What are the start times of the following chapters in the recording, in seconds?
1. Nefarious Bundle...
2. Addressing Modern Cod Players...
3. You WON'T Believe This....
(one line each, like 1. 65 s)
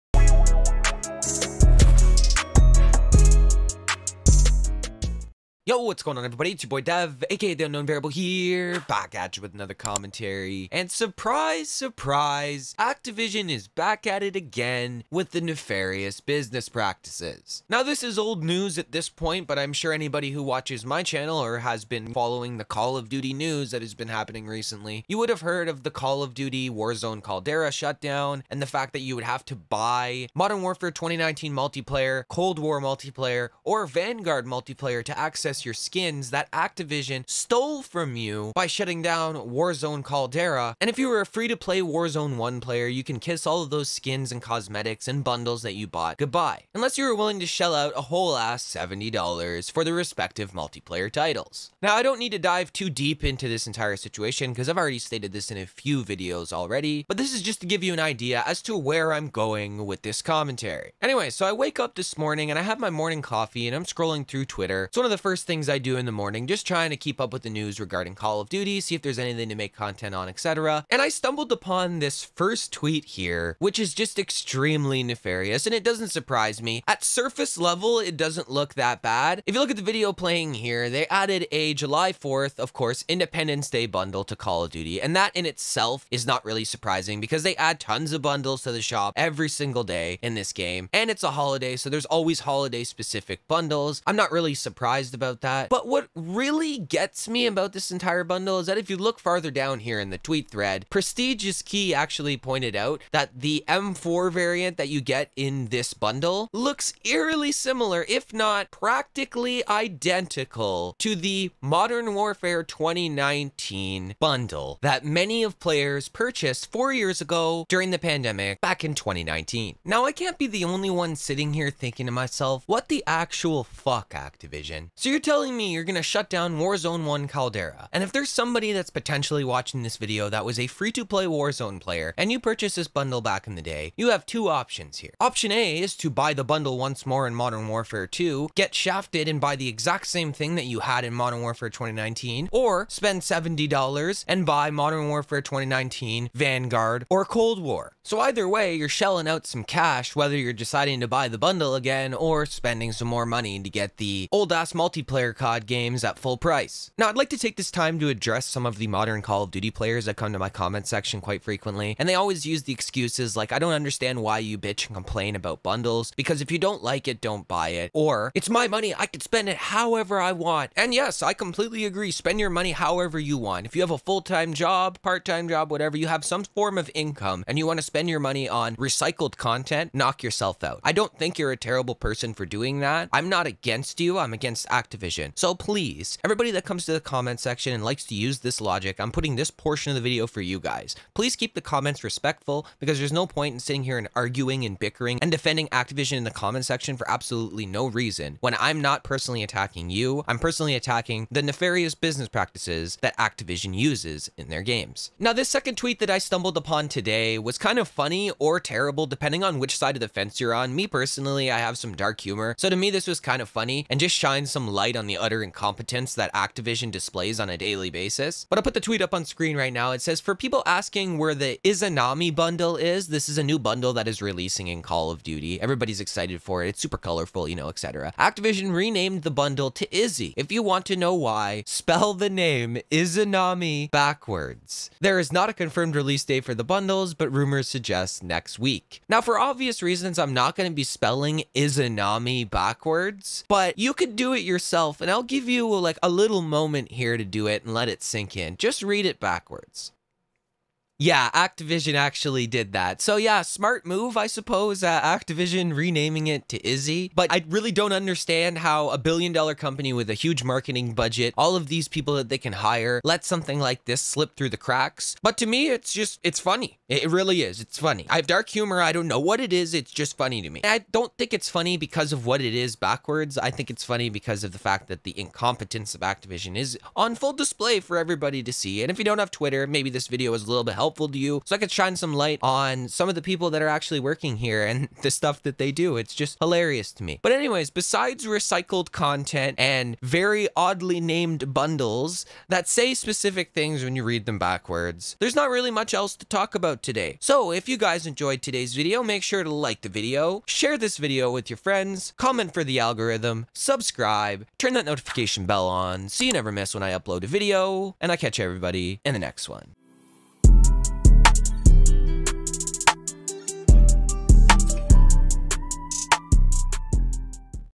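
1. 60 s
2. 156 s
3. 205 s.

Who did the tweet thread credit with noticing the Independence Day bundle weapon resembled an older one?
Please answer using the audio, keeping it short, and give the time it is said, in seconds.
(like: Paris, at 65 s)
Prestigious Key, at 100 s.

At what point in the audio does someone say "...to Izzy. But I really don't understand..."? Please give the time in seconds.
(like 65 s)
256 s.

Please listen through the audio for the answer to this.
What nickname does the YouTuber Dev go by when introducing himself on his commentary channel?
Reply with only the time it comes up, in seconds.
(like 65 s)
7 s.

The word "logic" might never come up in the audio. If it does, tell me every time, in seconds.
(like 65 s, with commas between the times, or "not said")
188 s.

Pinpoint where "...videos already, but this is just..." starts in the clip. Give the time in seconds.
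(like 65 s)
56 s.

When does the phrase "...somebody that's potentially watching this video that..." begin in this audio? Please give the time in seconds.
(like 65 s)
128 s.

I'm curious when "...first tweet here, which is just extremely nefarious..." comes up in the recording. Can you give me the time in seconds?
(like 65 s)
72 s.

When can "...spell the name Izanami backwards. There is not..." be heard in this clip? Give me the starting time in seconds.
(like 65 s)
231 s.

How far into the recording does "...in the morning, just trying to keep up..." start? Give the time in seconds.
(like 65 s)
65 s.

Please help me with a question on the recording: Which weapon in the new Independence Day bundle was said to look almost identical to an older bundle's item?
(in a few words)
M4.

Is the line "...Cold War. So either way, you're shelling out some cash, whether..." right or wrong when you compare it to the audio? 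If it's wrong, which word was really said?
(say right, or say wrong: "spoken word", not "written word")
right.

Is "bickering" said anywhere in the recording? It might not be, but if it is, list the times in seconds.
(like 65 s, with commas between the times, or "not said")
194 s.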